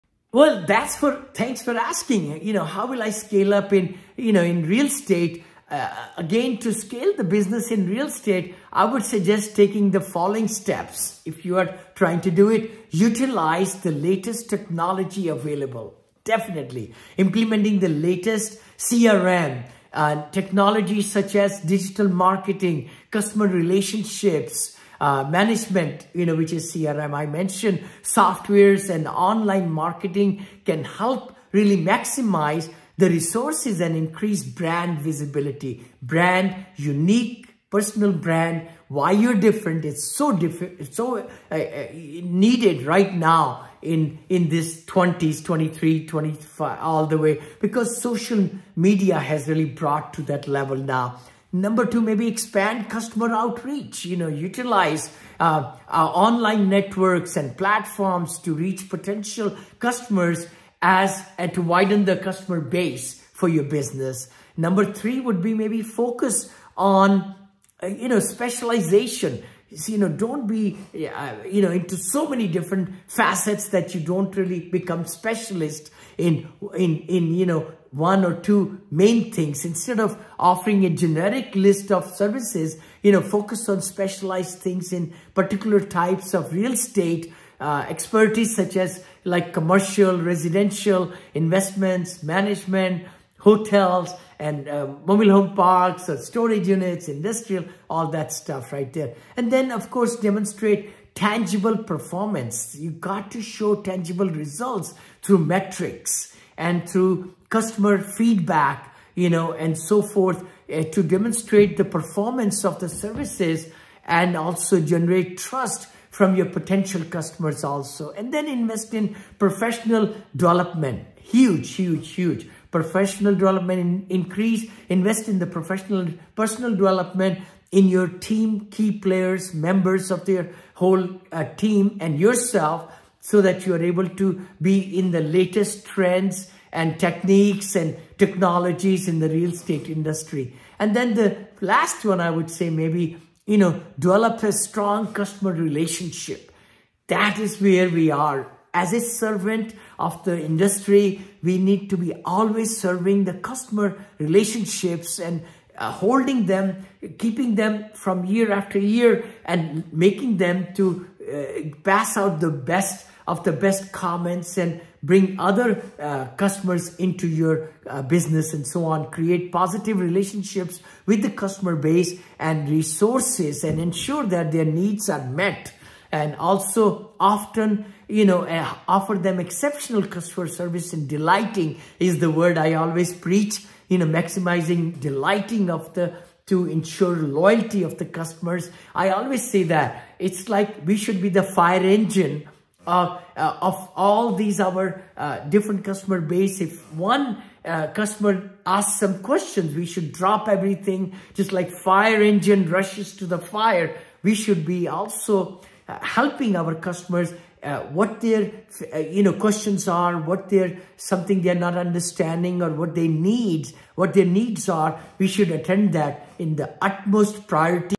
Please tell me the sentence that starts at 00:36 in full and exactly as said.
Brand, unique personal brand, why you're different.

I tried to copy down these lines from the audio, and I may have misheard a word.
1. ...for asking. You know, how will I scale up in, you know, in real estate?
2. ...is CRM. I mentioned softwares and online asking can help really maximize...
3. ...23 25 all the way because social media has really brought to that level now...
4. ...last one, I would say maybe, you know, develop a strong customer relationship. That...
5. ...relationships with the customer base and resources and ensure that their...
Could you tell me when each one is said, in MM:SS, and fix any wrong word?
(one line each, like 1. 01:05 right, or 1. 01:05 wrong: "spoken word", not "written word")
1. 00:01 right
2. 00:26 wrong: "marketing", not "asking"
3. 00:45 right
4. 02:21 right
5. 02:49 right.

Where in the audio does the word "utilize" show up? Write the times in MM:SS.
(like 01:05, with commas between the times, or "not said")
00:12, 00:54.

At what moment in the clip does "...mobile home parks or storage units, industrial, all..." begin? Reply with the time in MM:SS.
01:35.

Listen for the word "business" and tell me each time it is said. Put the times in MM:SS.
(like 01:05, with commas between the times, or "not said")
00:07, 01:03, 02:48.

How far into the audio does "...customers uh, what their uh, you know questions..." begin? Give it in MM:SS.
03:26.